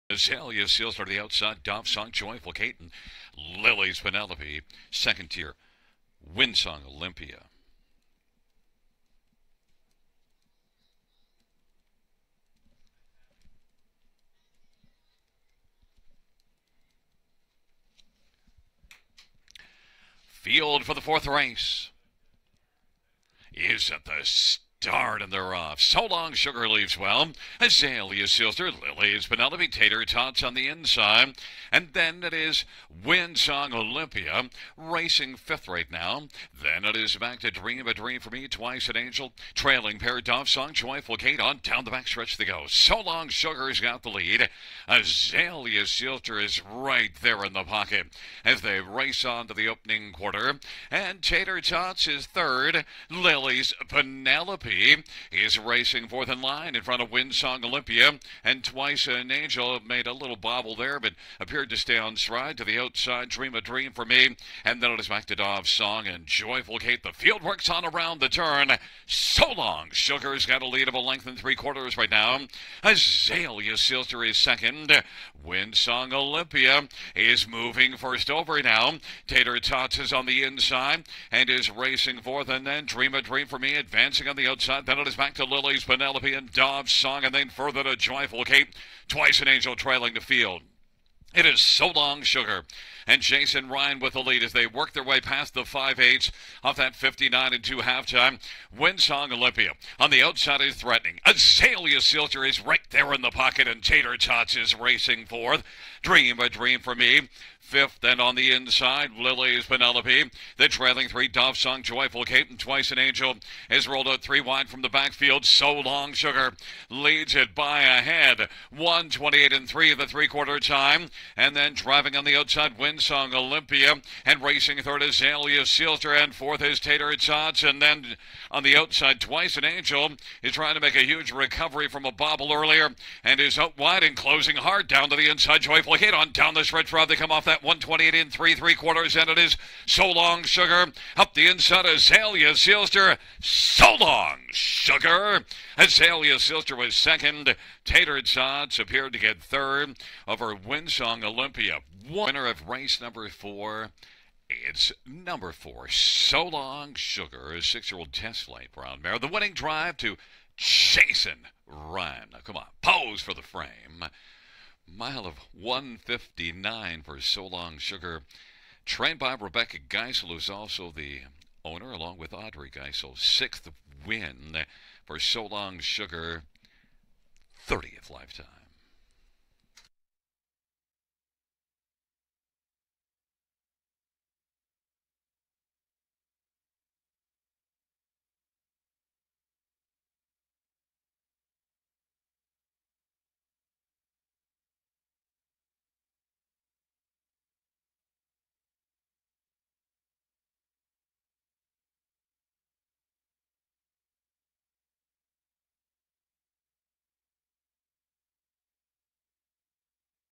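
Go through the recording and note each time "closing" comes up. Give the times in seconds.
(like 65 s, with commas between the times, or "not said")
134 s.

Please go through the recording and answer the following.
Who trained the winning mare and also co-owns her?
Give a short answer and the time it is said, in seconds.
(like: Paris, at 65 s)
Rebecca Geisel, at 169 s.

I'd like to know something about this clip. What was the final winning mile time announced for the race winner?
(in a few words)
1:59.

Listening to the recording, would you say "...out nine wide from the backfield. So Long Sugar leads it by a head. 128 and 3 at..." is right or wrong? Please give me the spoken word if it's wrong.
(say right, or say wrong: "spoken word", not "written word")
wrong: "three", not "nine".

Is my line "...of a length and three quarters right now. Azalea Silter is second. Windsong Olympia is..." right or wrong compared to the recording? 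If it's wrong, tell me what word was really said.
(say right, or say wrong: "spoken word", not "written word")
right.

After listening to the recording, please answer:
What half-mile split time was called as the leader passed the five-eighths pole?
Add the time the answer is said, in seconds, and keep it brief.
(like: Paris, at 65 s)
59 2/5 (59 and 2), at 96 s.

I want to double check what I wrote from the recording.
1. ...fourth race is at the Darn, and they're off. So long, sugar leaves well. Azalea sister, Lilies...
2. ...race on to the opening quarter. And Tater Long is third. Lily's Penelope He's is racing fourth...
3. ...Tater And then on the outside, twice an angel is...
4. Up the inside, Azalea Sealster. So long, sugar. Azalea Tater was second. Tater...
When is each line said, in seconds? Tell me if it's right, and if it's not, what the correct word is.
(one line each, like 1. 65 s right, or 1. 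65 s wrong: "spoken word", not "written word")
1. 21 s right
2. 48 s wrong: "Tots", not "Long"
3. 126 s right
4. 141 s wrong: "Sealster", not "Tater".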